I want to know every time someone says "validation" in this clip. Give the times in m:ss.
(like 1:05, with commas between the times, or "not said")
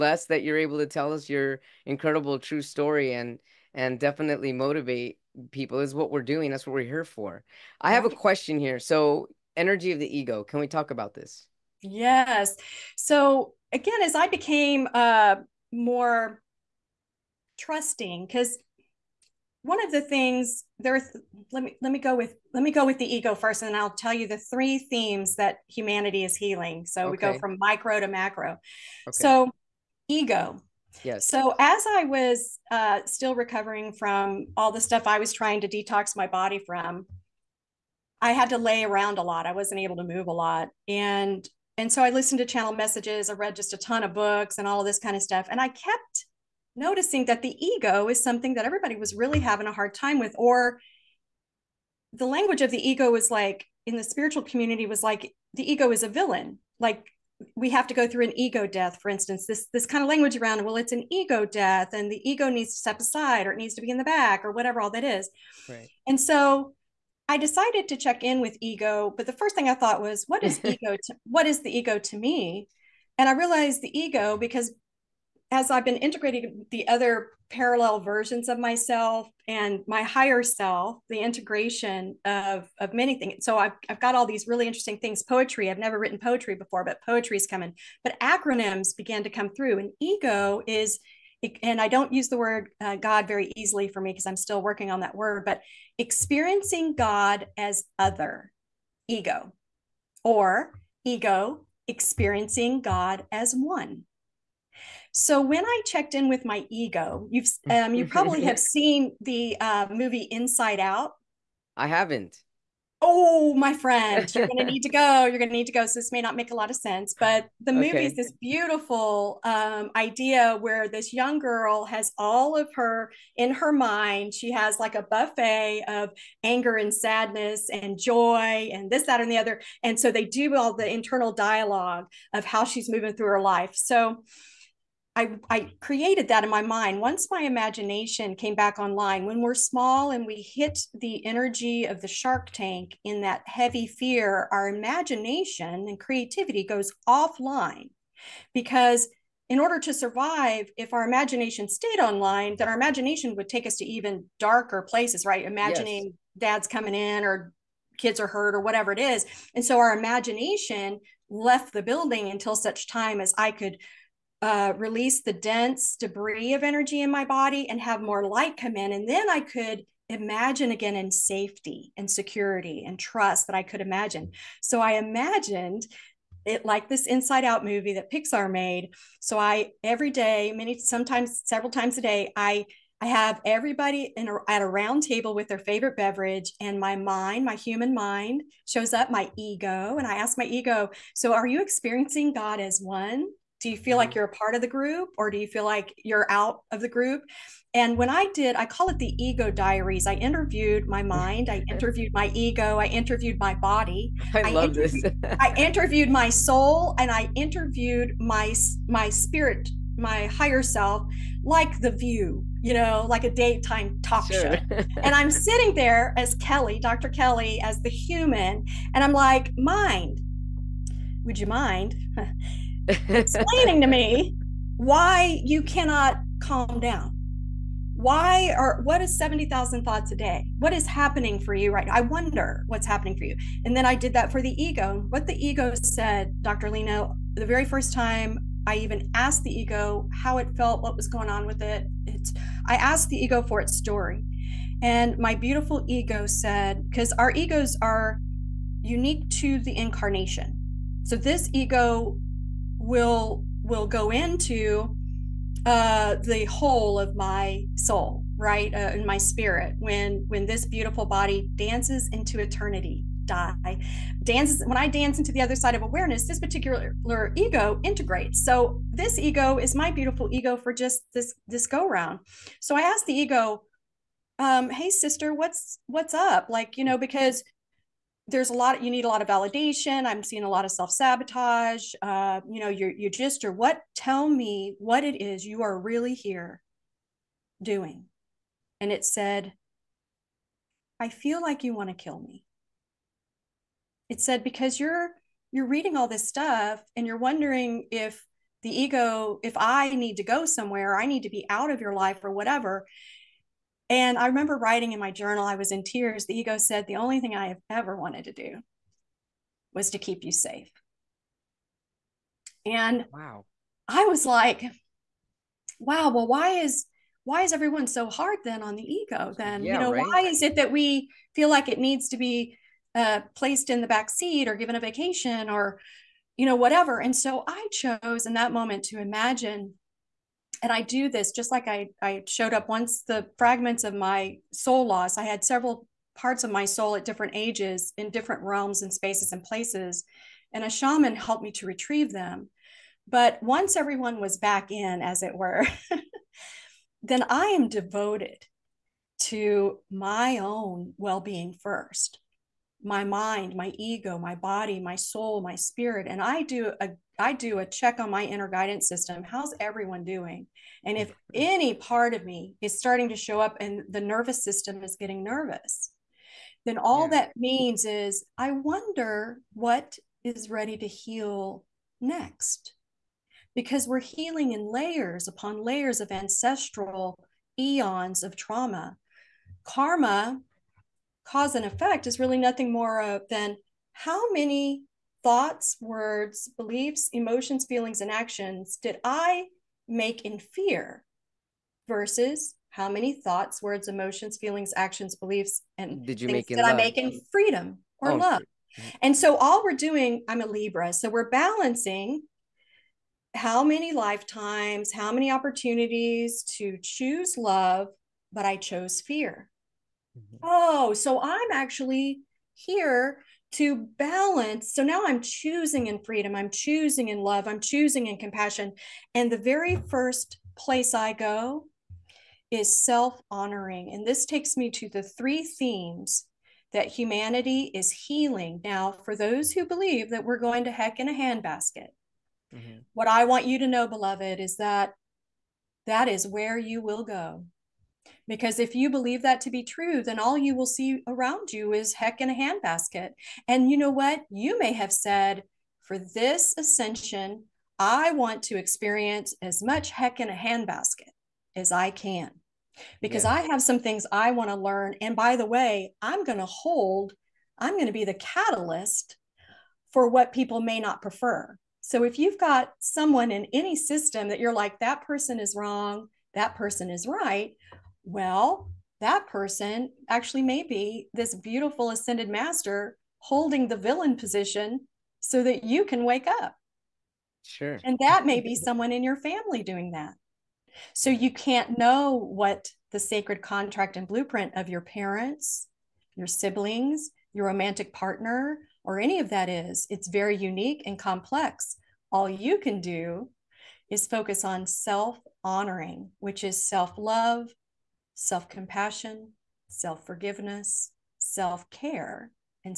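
4:39.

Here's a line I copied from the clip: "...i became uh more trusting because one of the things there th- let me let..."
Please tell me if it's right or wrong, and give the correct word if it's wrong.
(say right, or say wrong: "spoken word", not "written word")
right.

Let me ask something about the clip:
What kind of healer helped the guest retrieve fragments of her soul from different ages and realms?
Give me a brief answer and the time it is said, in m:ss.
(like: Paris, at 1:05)
a shaman, at 5:40.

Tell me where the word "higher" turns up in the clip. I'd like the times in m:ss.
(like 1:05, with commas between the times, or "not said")
1:20, 3:30.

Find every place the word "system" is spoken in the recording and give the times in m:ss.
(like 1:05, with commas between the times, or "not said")
5:58, 6:04, 7:43.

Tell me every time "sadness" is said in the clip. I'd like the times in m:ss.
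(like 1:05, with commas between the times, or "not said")
2:06.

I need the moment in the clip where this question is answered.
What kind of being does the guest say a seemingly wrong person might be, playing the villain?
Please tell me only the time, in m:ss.
7:51.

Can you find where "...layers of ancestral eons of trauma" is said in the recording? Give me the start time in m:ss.
6:15.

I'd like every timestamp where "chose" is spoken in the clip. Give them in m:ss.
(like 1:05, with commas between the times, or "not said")
5:27, 6:48.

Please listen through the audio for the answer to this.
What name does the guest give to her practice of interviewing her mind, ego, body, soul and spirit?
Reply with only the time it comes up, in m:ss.
3:18.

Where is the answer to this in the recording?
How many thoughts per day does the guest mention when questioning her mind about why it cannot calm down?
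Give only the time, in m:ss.
3:49.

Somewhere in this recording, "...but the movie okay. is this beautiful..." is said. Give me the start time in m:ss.
1:57.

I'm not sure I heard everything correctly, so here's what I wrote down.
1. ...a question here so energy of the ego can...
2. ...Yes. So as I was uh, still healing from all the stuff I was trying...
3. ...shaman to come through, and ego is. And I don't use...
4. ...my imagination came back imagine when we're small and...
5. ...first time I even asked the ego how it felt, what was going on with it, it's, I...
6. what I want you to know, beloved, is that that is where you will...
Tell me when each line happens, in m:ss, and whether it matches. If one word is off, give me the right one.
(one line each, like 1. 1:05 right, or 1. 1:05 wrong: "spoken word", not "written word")
1. 0:08 right
2. 0:31 wrong: "recovering", not "healing"
3. 1:28 wrong: "began", not "shaman"
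4. 2:17 wrong: "online", not "imagine"
5. 3:57 right
6. 7:12 right.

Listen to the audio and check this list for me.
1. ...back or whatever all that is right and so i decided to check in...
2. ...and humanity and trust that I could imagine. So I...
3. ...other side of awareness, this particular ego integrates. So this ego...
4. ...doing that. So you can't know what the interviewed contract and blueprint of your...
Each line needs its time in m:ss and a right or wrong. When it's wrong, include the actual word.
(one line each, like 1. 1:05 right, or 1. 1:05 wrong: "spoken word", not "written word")
1. 1:04 right
2. 2:51 wrong: "security", not "humanity"
3. 4:25 right
4. 7:59 wrong: "sacred", not "interviewed".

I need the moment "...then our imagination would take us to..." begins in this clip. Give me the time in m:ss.
2:32.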